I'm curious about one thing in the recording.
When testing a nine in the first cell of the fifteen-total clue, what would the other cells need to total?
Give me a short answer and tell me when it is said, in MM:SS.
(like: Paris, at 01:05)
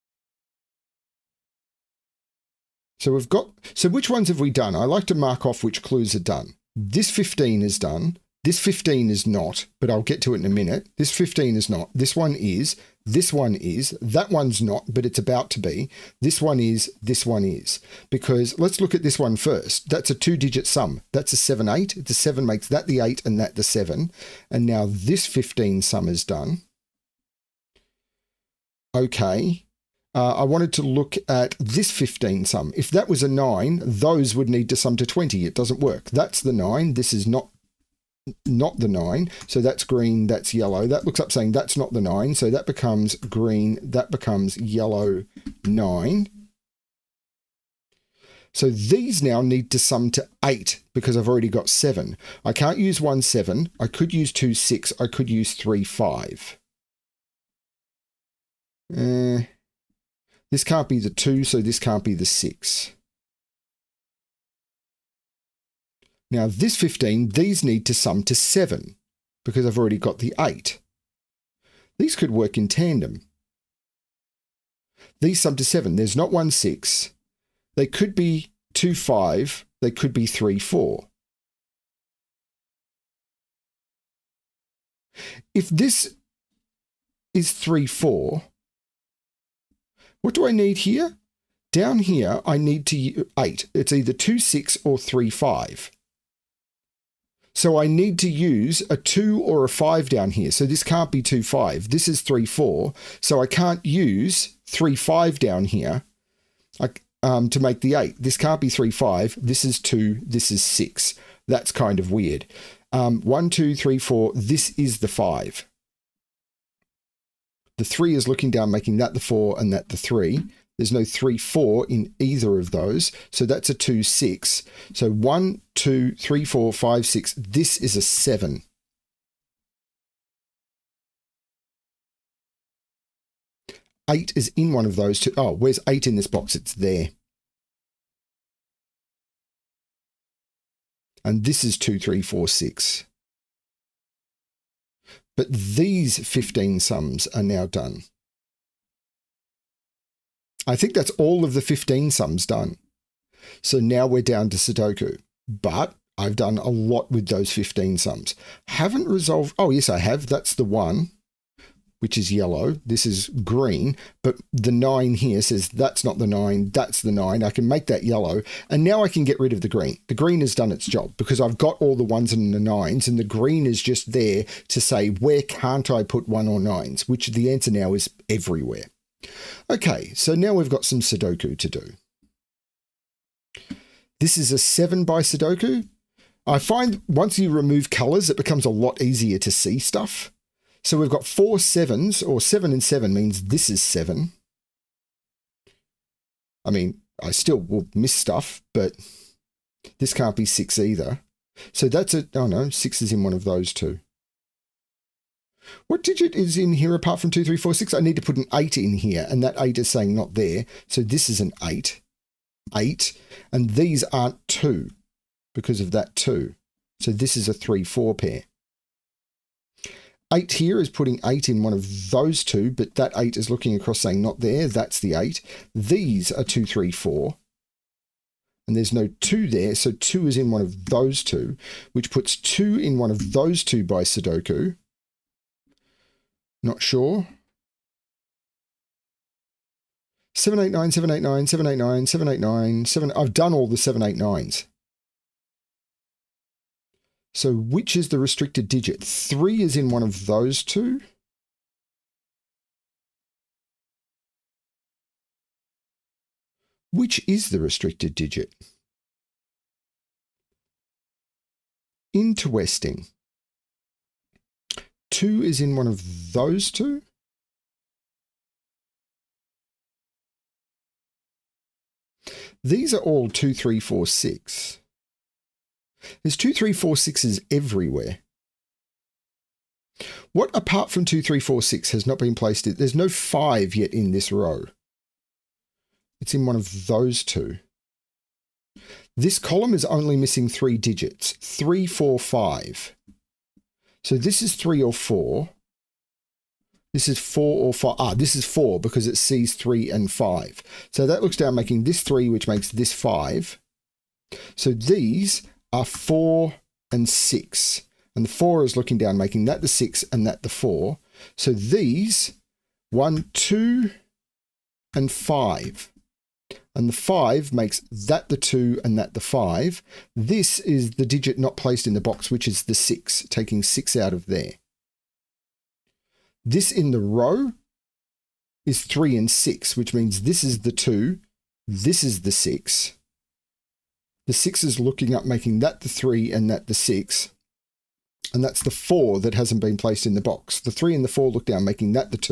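20, at 00:35.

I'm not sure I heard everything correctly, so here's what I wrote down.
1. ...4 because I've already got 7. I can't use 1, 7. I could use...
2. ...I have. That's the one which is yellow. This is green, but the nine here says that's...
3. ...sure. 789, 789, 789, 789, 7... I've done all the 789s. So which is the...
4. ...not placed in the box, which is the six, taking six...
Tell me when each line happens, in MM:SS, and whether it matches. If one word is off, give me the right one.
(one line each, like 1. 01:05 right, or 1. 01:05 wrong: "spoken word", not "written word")
1. 00:50 wrong: "8", not "4"
2. 02:39 right
3. 03:56 right
4. 05:21 right.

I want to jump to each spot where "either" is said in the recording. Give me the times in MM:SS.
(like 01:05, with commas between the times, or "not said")
01:33, 02:02, 03:20.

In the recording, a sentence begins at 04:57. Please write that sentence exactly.
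Ah, this is four because it sees three and five.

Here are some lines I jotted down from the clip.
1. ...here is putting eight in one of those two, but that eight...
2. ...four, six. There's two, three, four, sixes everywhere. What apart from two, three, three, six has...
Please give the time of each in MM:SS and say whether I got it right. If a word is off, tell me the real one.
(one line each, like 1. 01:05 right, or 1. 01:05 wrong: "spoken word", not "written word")
1. 03:40 right
2. 04:33 wrong: "four", not "three".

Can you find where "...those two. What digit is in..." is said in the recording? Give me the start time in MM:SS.
03:23.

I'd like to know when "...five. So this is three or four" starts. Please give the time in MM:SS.
04:52.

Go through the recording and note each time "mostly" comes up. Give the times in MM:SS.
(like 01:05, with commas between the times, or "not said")
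not said.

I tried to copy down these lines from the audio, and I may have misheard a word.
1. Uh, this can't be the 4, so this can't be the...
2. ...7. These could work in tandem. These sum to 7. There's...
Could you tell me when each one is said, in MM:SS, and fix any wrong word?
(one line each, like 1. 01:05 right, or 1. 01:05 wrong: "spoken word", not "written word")
1. 00:58 wrong: "2", not "4"
2. 01:10 wrong: "8", not "7".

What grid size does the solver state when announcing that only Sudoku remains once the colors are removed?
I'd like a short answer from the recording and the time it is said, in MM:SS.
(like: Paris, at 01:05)
7 by, at 03:04.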